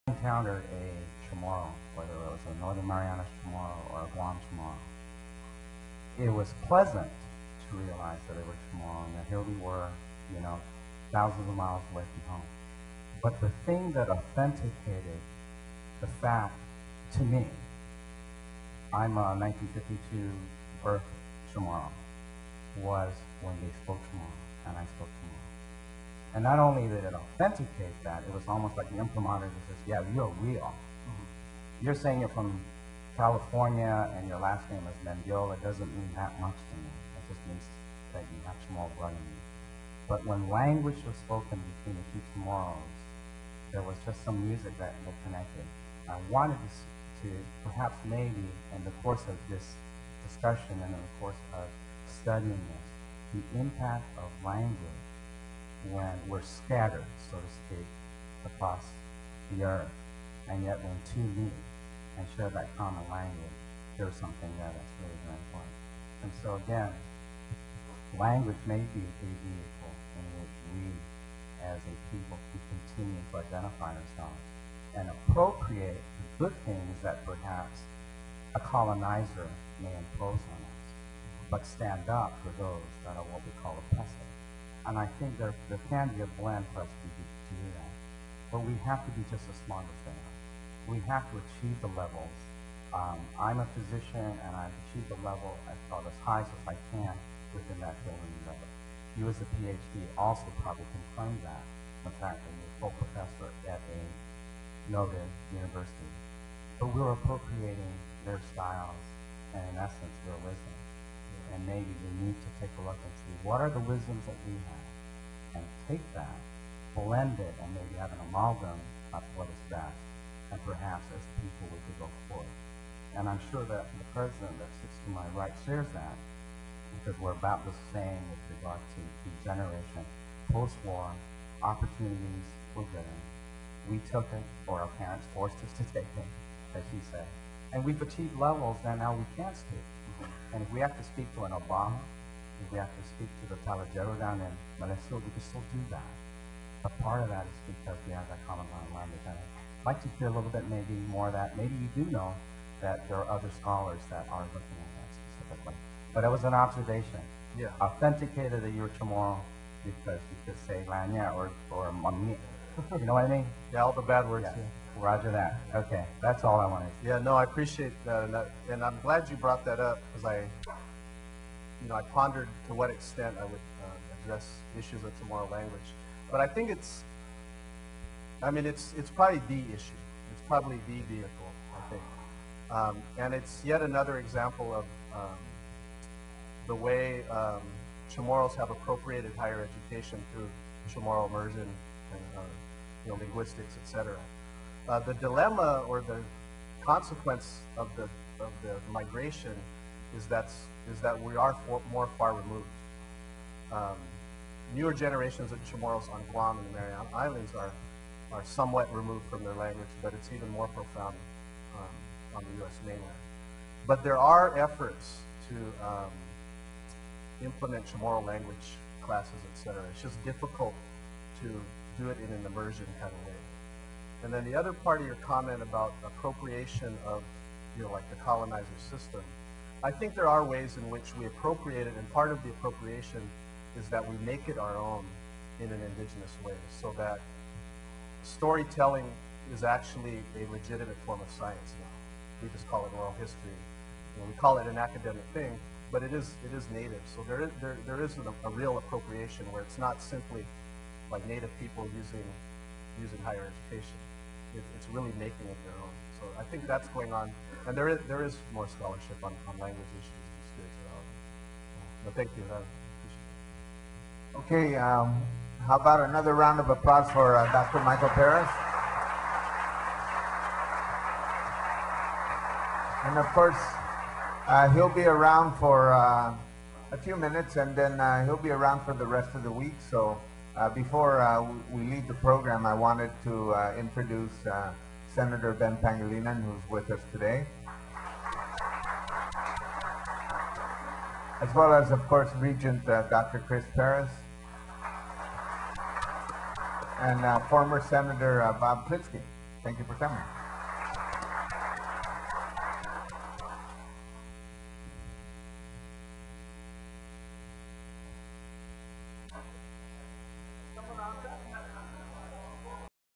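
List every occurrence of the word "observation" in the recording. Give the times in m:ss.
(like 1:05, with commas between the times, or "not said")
2:36.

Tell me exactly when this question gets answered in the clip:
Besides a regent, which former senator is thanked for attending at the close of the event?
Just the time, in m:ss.
4:58.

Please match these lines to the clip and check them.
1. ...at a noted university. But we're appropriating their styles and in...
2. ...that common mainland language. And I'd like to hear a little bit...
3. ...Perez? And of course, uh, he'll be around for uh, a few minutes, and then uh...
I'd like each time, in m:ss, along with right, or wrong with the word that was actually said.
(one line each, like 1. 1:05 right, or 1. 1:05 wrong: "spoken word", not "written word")
1. 1:43 right
2. 2:28 wrong: "ground", not "mainland"
3. 4:28 right.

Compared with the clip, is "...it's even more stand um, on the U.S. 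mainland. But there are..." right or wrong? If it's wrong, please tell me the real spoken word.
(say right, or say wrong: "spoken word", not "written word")
wrong: "profound", not "stand".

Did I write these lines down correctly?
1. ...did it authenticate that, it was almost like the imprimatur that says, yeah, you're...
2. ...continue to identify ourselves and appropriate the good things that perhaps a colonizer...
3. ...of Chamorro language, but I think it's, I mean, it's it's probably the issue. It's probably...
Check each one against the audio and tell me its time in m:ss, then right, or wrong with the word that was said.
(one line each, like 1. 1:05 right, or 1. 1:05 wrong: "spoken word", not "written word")
1. 0:26 right
2. 1:12 right
3. 2:55 right.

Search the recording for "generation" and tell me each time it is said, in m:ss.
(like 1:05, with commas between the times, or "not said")
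2:09, 3:24.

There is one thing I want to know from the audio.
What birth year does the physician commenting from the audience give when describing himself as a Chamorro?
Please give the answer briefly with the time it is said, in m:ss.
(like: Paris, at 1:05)
1952, at 0:19.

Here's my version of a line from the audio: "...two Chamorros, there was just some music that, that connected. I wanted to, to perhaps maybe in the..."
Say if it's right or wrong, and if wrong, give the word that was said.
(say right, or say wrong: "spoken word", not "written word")
right.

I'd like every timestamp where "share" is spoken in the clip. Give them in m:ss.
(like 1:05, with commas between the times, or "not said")
1:02, 2:05.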